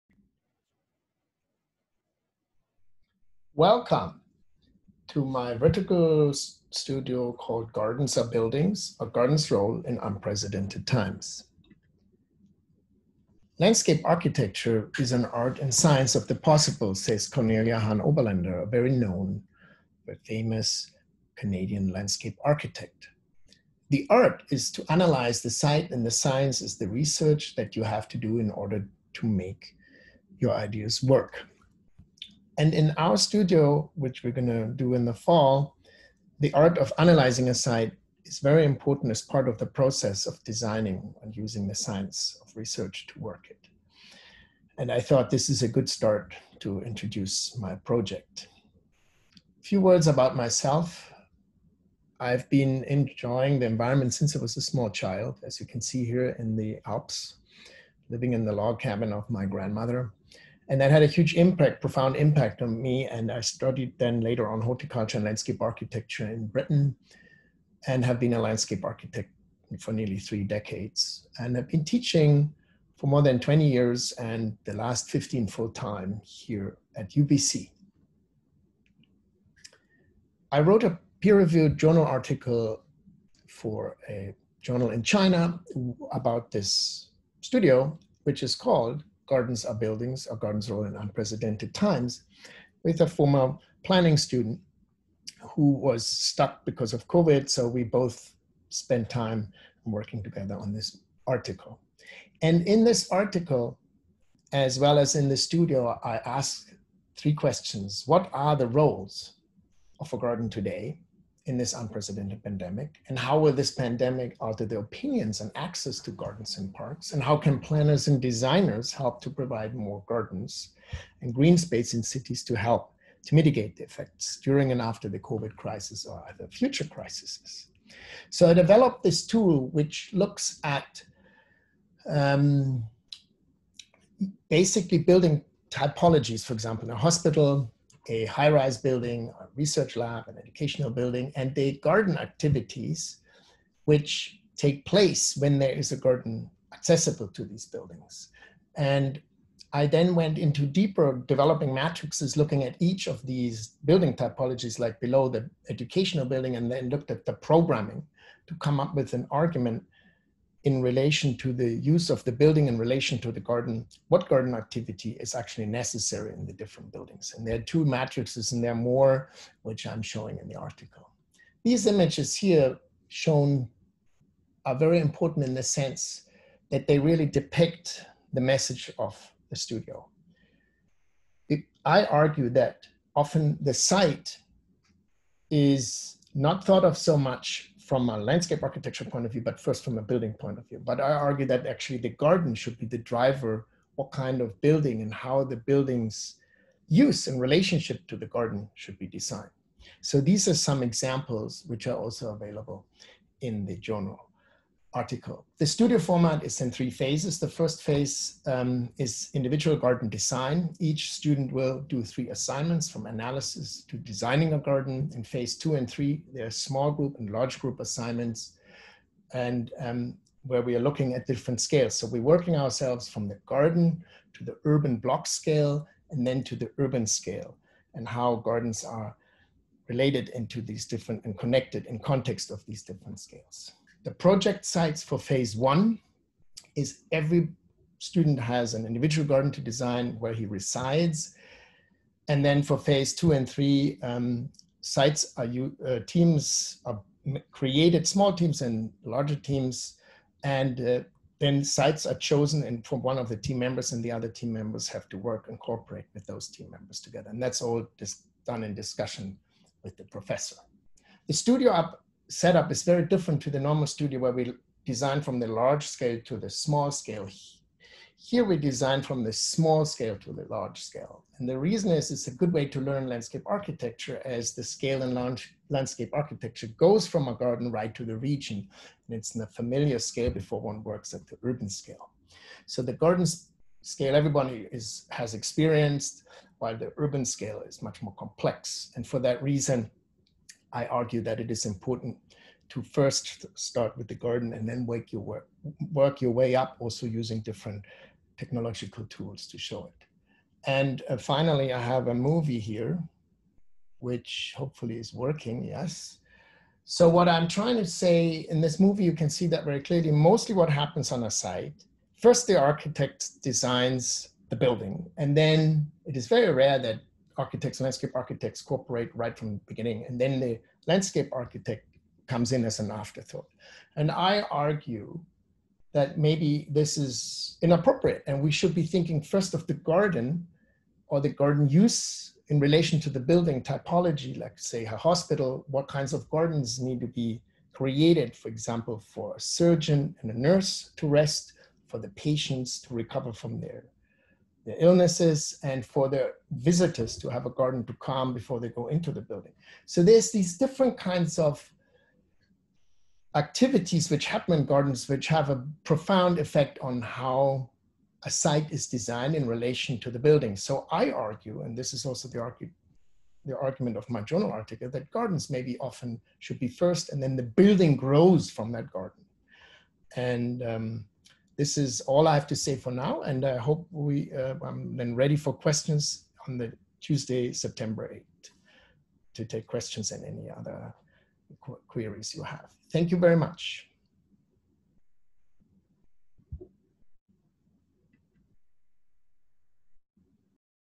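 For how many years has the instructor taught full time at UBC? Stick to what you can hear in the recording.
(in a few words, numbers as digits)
15.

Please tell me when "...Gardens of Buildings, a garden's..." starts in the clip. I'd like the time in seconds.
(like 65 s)
7 s.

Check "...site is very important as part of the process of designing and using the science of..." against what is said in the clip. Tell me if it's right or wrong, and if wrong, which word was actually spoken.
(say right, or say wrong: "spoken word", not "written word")
right.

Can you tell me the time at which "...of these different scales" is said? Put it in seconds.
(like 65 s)
232 s.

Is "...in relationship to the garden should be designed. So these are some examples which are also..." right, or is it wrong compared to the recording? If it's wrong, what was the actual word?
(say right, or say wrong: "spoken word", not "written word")
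right.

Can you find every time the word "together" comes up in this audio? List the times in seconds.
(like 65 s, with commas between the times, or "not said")
100 s, 256 s.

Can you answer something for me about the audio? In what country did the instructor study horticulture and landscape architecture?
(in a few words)
Britain.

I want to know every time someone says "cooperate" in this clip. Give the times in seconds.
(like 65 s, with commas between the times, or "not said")
255 s, 318 s.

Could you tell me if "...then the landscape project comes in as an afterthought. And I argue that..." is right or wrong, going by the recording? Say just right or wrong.
wrong.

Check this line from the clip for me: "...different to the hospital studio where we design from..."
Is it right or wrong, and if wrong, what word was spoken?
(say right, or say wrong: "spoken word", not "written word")
wrong: "normal", not "hospital".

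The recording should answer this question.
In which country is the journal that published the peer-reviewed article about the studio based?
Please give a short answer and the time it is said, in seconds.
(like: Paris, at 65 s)
China, at 85 s.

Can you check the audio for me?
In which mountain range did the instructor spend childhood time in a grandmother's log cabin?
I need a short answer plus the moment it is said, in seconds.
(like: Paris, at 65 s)
The Alps, at 56 s.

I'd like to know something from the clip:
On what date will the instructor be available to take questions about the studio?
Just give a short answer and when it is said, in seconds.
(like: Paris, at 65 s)
Tuesday, September 8th, at 377 s.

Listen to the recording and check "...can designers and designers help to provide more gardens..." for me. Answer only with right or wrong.
wrong.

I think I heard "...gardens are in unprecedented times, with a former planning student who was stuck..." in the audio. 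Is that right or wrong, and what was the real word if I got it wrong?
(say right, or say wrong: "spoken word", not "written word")
right.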